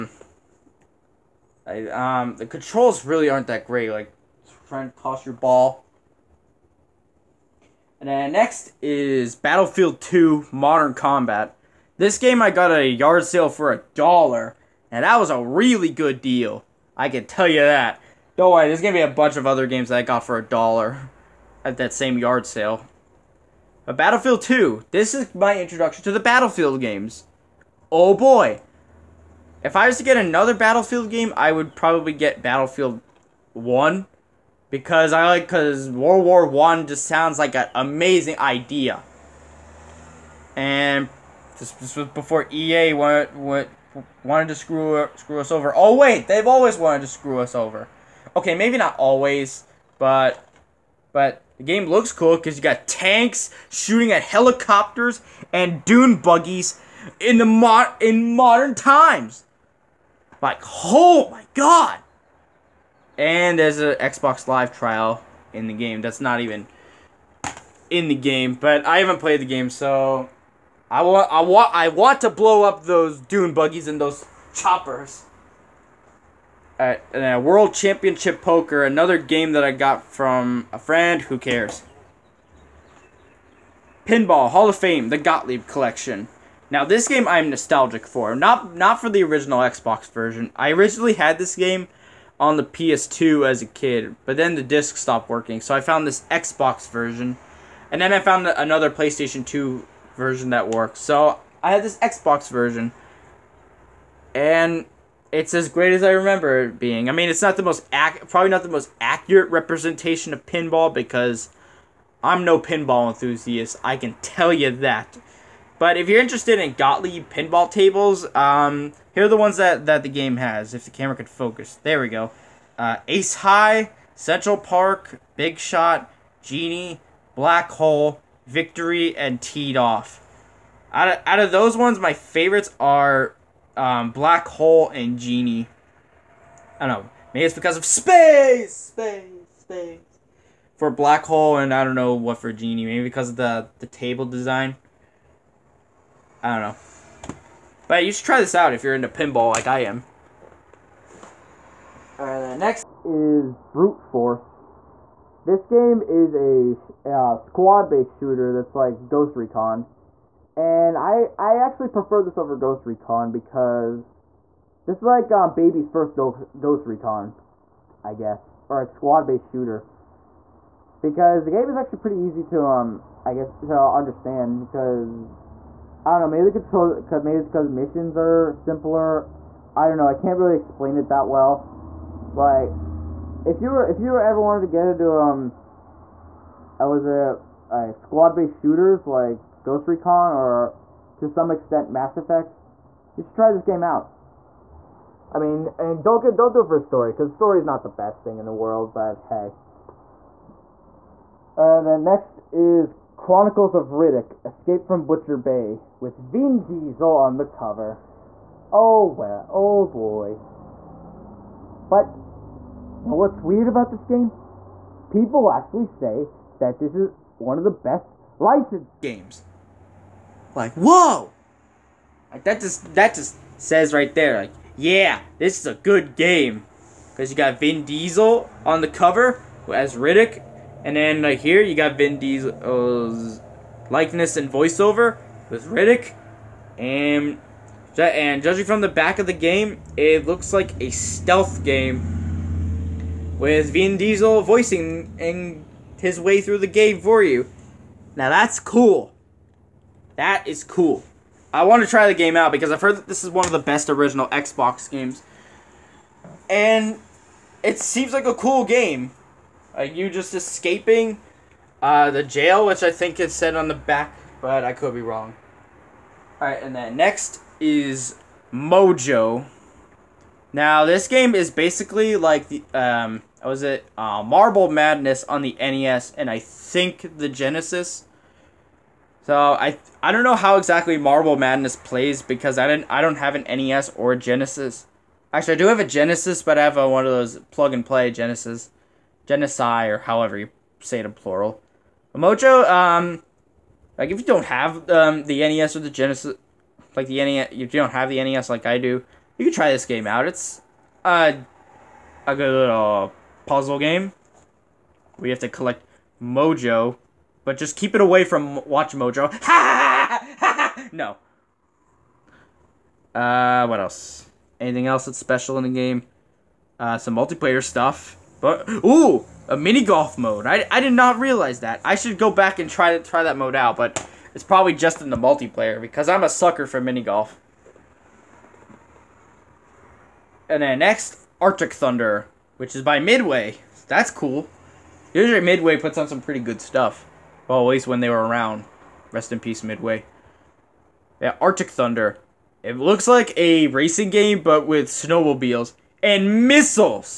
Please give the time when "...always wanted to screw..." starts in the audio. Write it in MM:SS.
00:46.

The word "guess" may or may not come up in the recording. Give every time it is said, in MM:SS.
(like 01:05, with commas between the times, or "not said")
02:48, 02:53.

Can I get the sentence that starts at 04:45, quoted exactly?
Actually, I do have a Genesis, but I have a, one of those plug and play Genesis.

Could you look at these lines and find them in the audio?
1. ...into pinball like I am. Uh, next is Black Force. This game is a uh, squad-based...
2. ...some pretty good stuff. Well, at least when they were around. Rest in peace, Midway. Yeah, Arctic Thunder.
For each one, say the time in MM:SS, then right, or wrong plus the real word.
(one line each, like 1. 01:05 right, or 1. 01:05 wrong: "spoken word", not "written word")
1. 02:28 wrong: "Brute", not "Black"
2. 05:36 right.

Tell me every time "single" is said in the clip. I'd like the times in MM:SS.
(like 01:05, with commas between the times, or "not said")
not said.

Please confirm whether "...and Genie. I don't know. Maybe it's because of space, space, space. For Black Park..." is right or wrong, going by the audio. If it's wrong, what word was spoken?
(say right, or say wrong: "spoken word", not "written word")
wrong: "Hole", not "Park".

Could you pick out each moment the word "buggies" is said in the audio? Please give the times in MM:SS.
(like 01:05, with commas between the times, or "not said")
00:56, 01:13.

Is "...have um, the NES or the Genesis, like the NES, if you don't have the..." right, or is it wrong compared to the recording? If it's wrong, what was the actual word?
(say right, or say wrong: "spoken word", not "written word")
right.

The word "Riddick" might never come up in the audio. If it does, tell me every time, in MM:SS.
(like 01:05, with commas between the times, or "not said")
03:23, 03:49, 03:55.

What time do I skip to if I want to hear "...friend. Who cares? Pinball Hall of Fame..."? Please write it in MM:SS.
01:20.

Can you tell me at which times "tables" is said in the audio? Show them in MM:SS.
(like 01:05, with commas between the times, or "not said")
01:57, 02:23.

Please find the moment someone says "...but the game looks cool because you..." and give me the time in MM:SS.
00:51.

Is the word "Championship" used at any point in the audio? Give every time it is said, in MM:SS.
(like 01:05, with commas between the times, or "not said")
01:17.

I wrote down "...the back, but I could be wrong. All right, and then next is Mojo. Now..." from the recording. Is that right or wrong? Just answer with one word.
right.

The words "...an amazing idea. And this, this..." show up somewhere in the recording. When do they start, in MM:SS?
00:37.